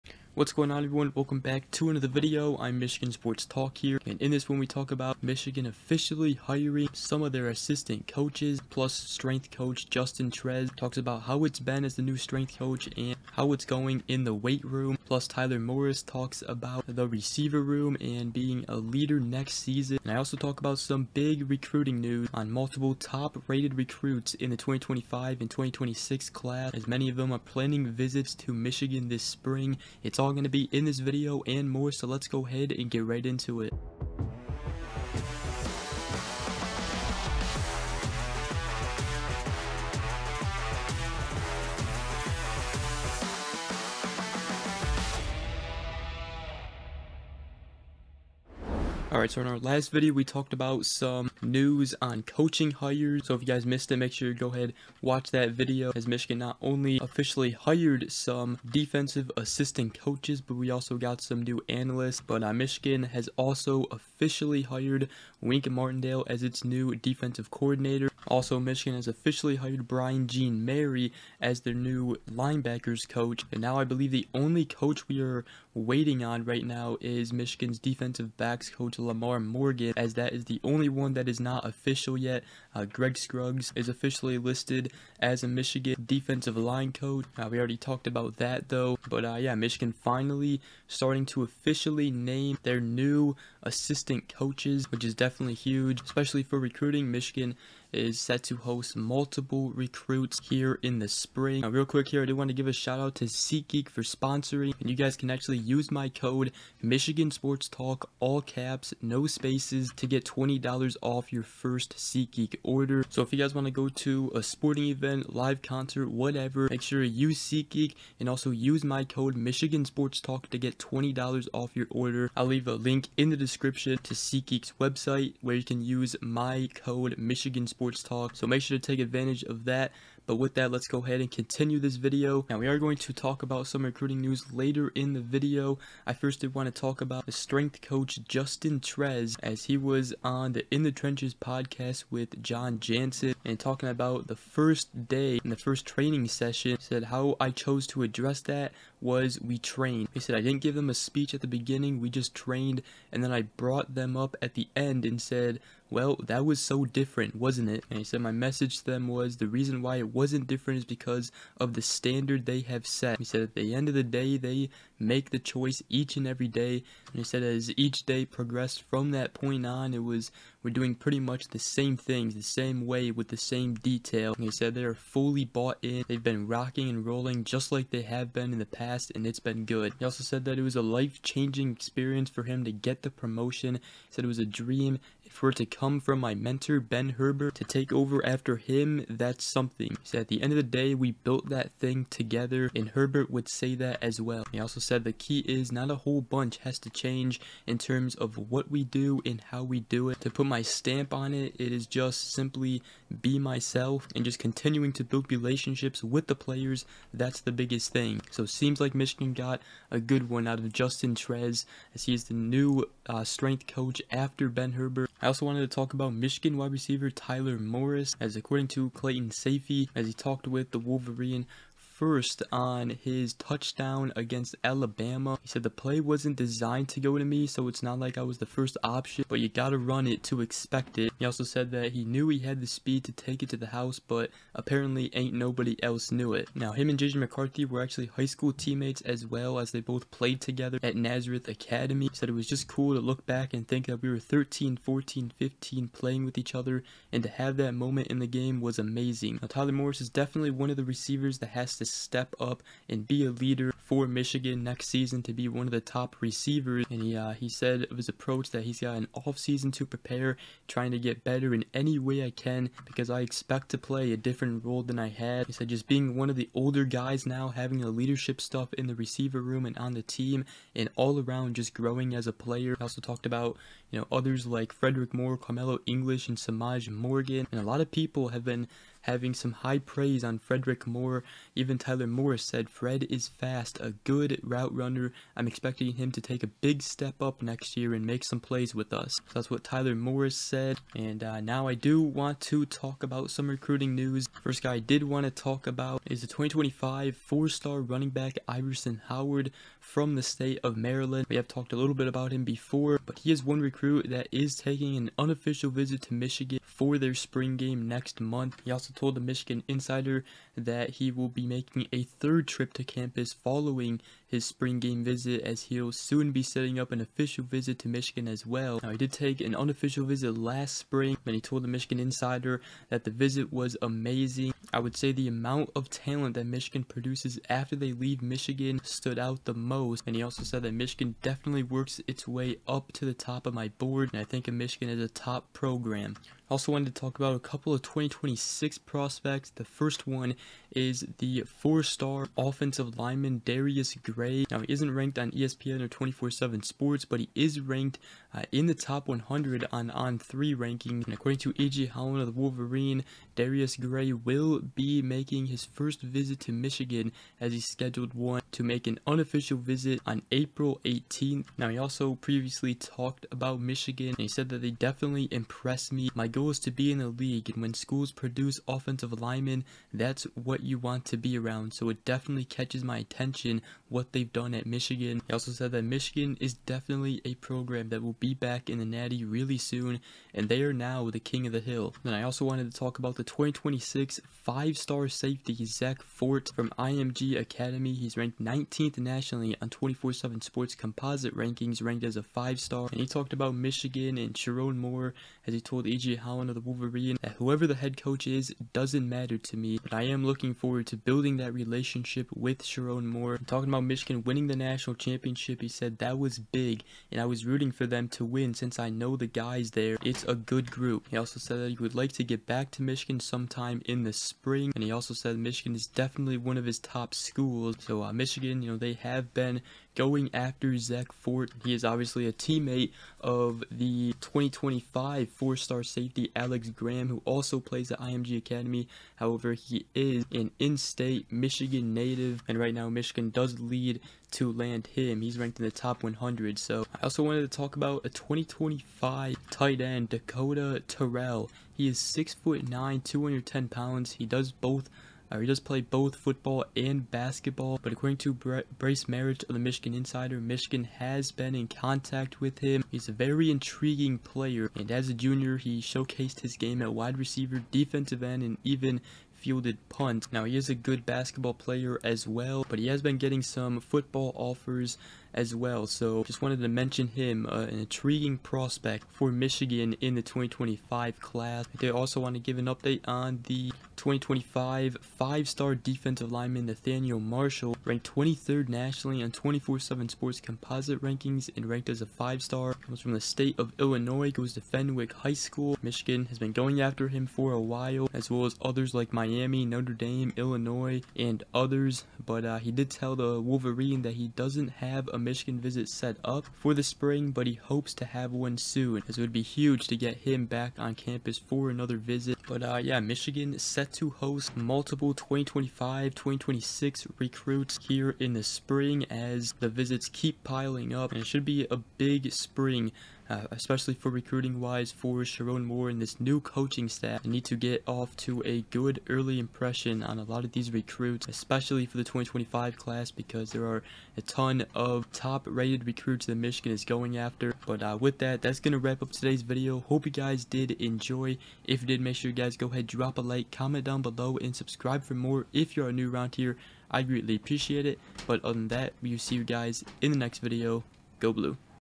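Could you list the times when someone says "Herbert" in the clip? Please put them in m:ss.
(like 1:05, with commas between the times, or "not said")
3:07, 3:12, 3:34.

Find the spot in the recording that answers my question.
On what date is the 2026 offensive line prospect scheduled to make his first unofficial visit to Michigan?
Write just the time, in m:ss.
6:00.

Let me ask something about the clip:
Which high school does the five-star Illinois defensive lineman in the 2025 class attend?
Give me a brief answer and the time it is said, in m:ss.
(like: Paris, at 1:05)
Fenwick High School, at 8:04.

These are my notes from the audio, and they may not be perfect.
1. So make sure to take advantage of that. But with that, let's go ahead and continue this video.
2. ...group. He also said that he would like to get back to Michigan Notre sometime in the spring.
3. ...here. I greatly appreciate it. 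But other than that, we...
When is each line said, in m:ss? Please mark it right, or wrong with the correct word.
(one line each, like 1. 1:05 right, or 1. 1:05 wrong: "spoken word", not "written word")
1. 2:08 right
2. 6:50 wrong: "Michigan", not "Notre"
3. 8:56 right.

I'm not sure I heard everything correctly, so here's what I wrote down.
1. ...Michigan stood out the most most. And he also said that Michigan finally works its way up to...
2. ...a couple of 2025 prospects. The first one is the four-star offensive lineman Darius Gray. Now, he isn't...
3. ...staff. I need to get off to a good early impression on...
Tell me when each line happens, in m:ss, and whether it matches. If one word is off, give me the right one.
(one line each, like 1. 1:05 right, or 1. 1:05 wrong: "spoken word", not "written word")
1. 5:28 wrong: "definitely", not "finally"
2. 5:37 wrong: "2026", not "2025"
3. 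8:36 right.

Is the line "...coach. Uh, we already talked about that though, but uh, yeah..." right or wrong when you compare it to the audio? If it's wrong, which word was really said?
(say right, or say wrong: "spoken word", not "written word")
right.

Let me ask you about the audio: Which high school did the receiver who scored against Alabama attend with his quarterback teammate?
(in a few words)
Nazareth Academy.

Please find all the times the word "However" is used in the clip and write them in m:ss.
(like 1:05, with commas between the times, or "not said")
7:09.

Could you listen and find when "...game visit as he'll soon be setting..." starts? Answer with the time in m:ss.
5:14.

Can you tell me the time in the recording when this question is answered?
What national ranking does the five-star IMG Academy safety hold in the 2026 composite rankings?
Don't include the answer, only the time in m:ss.
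6:28.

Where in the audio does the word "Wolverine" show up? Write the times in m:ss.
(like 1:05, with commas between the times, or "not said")
3:40, 5:52, 6:36, 8:13.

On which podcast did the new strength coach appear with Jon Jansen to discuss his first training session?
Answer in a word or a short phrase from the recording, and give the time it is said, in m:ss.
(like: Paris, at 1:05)
In the Trenches, at 2:20.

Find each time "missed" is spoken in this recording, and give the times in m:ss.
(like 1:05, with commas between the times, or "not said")
0:53.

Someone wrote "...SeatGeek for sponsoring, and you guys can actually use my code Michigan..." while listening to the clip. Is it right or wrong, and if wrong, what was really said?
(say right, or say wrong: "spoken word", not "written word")
right.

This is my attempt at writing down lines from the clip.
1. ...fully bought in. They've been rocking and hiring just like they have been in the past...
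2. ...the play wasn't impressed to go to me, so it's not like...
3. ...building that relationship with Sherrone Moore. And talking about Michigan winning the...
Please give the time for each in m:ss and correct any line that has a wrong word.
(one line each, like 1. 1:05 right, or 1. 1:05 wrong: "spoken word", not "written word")
1. 2:54 wrong: "rolling", not "hiring"
2. 3:45 wrong: "designed", not "impressed"
3. 6:40 right.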